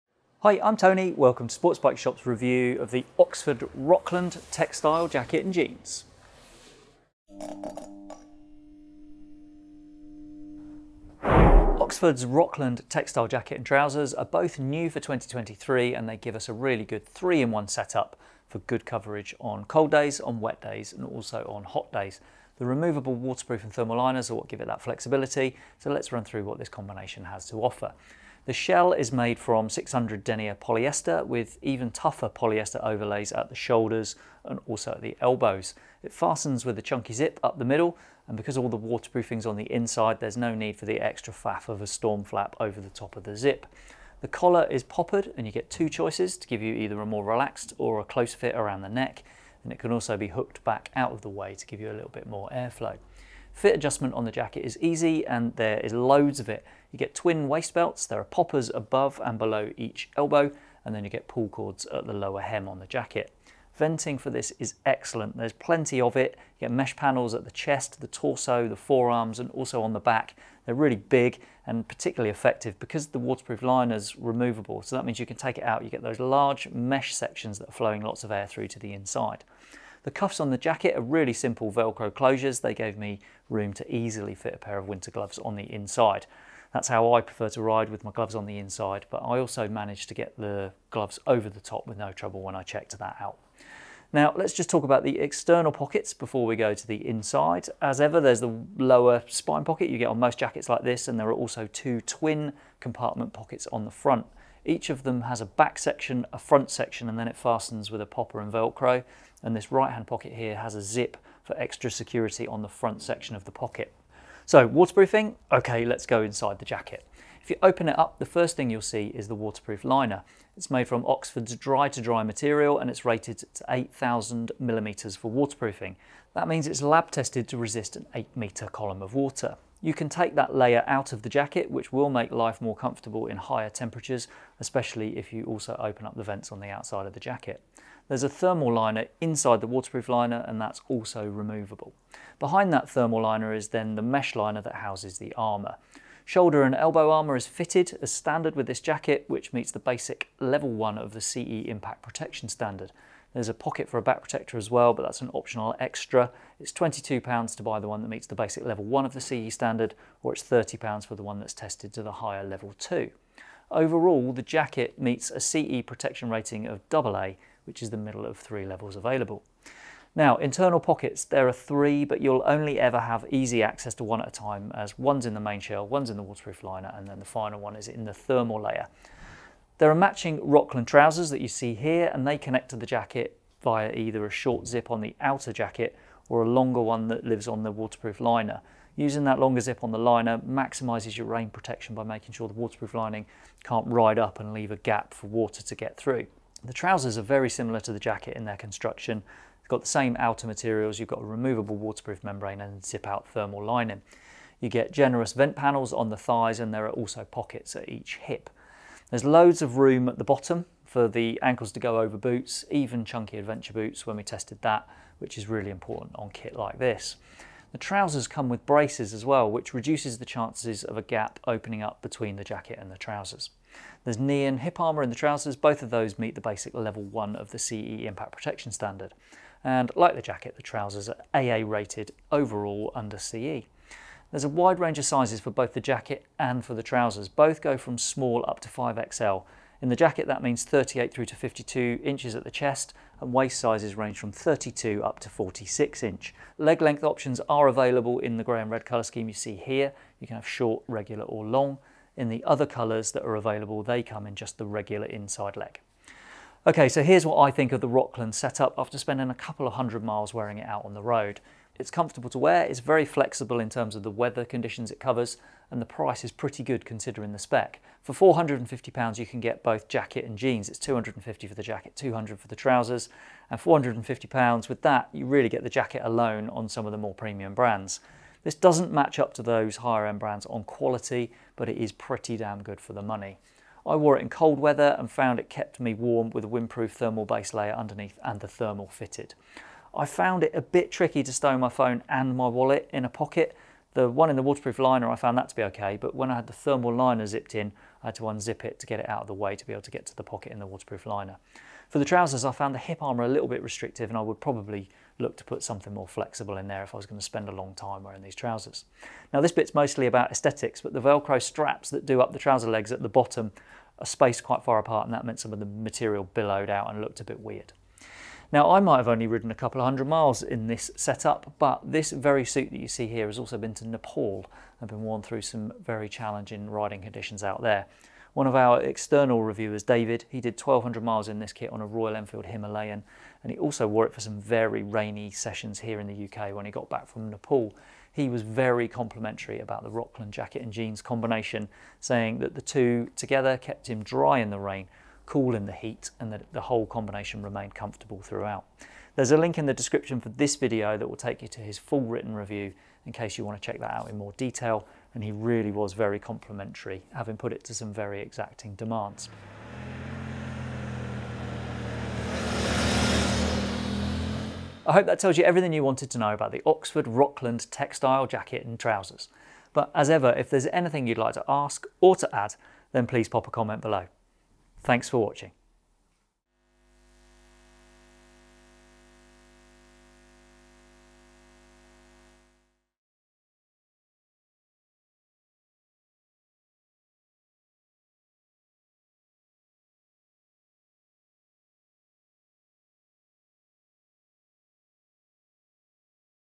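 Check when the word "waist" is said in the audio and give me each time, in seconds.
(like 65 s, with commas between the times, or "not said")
57 s, 243 s.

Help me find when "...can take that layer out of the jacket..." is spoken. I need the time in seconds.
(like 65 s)
129 s.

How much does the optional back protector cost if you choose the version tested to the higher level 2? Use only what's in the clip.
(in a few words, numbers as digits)
£30.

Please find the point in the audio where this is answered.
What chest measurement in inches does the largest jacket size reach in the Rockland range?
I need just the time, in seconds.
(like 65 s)
241 s.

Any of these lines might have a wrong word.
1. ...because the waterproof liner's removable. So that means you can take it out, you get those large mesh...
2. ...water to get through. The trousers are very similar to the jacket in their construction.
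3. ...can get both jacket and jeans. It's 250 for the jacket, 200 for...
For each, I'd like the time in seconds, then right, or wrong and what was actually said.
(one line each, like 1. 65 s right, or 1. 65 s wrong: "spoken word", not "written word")
1. 72 s right
2. 195 s right
3. 269 s right.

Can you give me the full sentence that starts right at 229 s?
And like the jacket, the trousers are AA rated overall under CE.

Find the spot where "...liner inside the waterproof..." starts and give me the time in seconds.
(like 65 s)
138 s.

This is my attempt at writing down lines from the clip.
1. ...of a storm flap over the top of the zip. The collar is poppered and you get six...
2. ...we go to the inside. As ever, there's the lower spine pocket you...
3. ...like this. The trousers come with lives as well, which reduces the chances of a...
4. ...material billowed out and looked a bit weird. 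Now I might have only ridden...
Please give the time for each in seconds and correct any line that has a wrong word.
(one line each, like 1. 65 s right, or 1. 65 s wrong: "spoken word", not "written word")
1. 41 s wrong: "two", not "six"
2. 96 s right
3. 216 s wrong: "braces", not "lives"
4. 315 s right.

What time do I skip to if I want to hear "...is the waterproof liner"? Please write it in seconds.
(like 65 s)
119 s.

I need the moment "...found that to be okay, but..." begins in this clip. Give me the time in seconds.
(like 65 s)
295 s.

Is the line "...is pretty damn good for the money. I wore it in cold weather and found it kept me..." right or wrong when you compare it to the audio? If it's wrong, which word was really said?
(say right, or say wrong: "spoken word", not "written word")
right.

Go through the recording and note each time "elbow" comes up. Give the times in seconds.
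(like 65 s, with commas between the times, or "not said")
35 s, 60 s, 146 s.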